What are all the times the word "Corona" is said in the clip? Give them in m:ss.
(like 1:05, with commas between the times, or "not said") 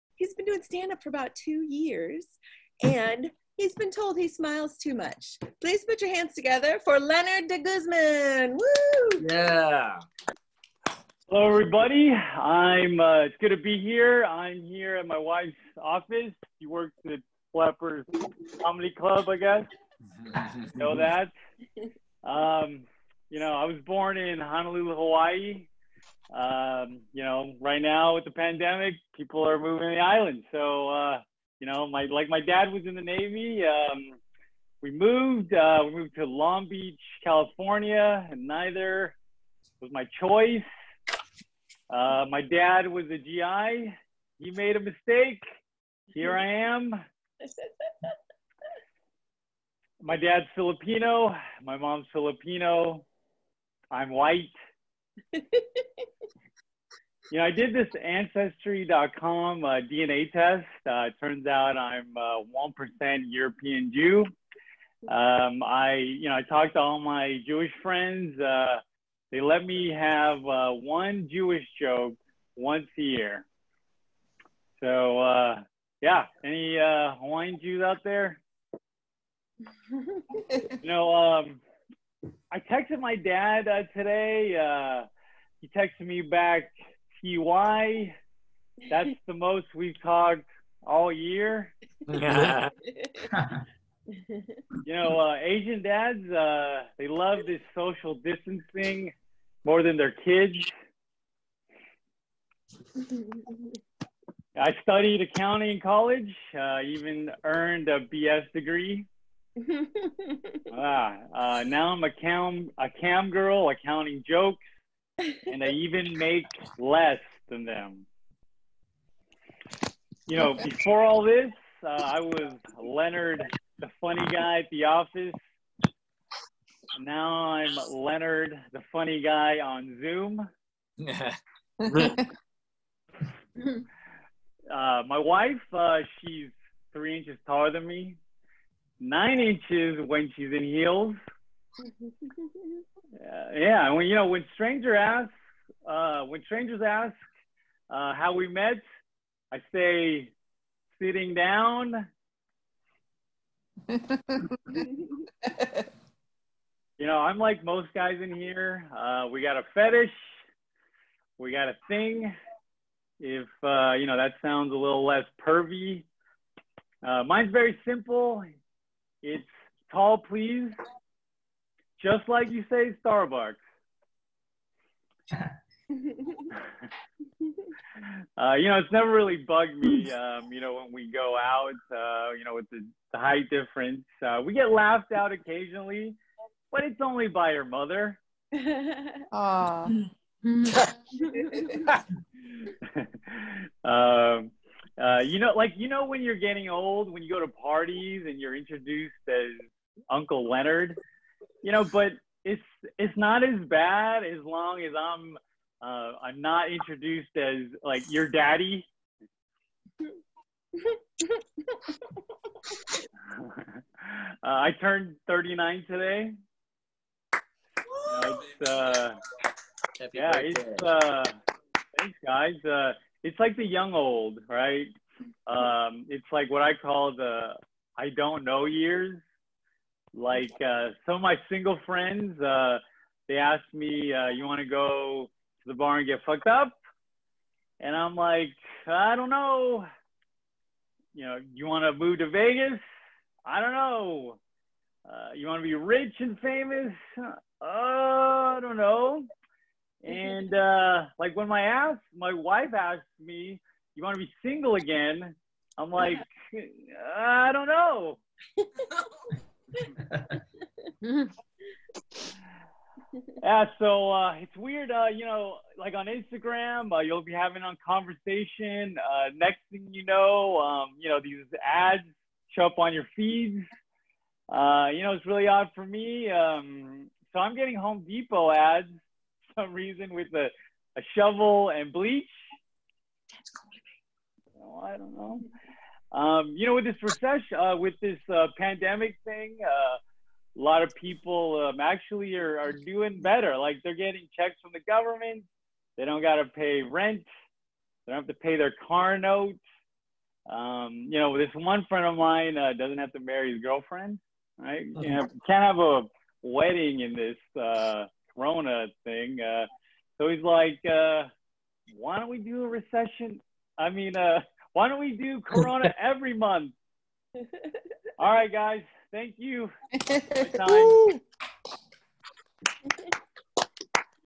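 5:08, 5:15.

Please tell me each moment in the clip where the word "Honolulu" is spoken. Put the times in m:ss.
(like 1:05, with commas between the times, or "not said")
0:24.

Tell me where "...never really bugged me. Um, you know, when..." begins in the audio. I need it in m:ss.
2:58.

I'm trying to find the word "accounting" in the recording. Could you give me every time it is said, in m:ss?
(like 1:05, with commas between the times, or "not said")
1:45, 1:53.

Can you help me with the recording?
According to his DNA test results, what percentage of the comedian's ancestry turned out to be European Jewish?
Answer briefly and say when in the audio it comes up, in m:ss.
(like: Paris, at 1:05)
1%, at 1:03.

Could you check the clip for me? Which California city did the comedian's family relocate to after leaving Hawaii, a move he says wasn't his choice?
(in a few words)
Long Beach.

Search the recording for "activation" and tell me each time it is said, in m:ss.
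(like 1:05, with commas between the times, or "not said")
not said.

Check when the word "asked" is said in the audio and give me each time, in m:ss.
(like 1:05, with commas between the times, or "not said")
3:53, 4:12.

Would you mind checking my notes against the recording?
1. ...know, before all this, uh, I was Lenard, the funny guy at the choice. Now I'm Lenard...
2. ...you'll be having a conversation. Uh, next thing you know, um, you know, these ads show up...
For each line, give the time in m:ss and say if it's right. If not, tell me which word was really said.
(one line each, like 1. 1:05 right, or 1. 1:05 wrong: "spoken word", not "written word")
1. 2:00 wrong: "office", not "choice"
2. 4:26 right.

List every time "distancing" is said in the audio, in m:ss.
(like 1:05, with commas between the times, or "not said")
1:38.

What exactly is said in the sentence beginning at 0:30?
So, uh, you know, my like my dad was in the Navy.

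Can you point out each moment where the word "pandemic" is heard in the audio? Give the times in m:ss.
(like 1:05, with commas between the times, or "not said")
0:28, 4:48.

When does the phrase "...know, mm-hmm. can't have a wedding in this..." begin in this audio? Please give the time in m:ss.
5:04.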